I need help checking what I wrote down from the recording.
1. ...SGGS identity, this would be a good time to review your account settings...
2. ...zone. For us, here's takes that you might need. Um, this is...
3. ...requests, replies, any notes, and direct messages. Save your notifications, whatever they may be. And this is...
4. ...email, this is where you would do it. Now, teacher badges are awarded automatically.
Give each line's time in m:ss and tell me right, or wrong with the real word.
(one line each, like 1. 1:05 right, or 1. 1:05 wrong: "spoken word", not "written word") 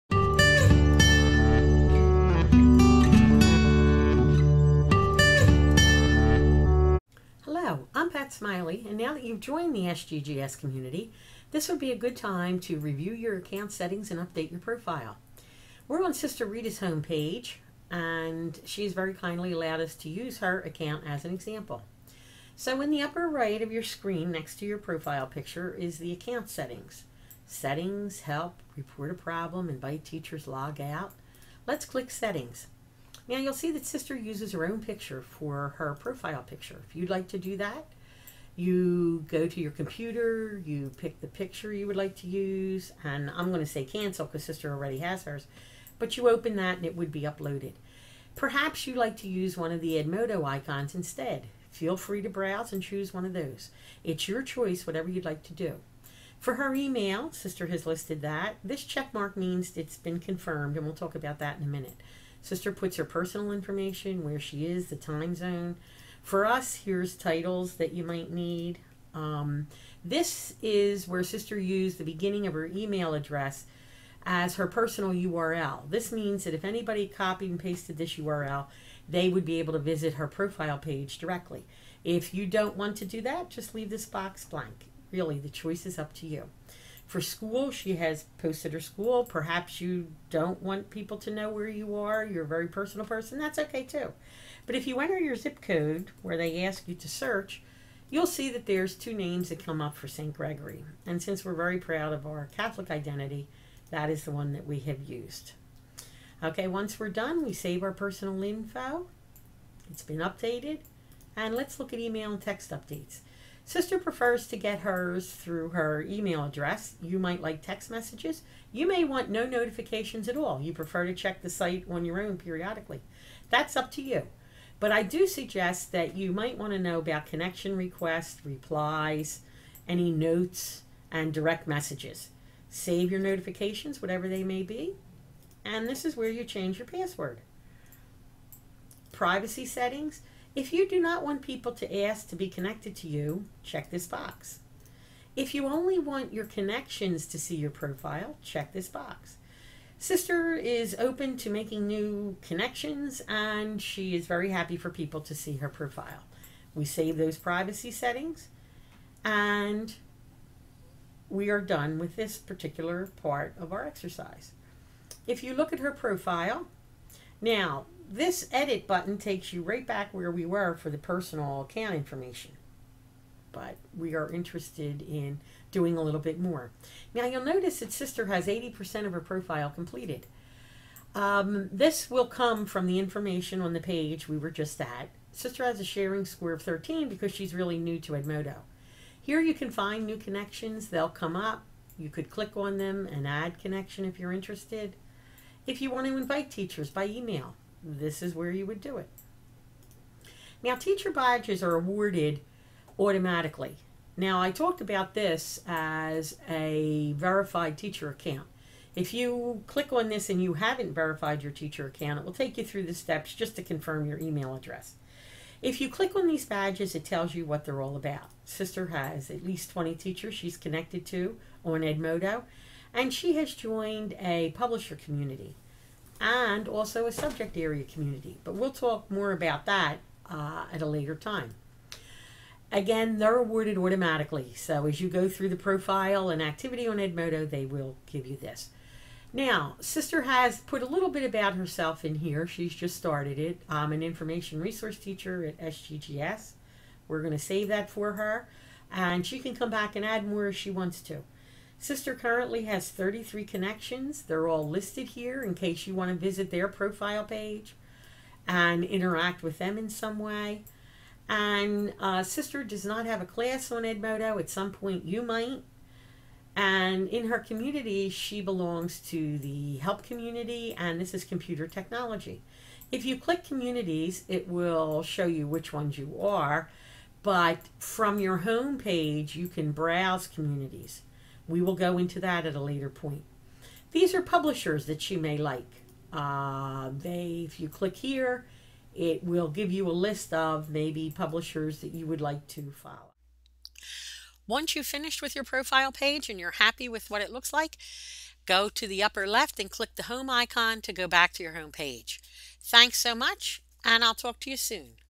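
1. 0:09 wrong: "community", not "identity"
2. 1:05 wrong: "titles", not "takes"
3. 2:07 right
4. 3:17 right.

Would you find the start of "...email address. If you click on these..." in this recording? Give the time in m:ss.
3:34.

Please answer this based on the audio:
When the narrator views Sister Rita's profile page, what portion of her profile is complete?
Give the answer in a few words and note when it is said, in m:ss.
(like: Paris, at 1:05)
80%, at 2:58.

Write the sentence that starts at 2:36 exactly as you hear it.
We save those privacy settings and we are done with this particular part of our exercise.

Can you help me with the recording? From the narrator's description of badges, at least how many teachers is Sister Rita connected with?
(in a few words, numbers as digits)
20.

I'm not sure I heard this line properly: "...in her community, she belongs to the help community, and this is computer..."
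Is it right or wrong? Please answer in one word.
right.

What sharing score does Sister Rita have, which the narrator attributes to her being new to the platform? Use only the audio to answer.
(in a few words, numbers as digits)
13.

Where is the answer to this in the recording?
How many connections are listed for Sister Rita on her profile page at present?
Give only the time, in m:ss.
4:12.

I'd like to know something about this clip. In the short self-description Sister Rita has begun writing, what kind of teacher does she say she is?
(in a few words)
information resource teacher.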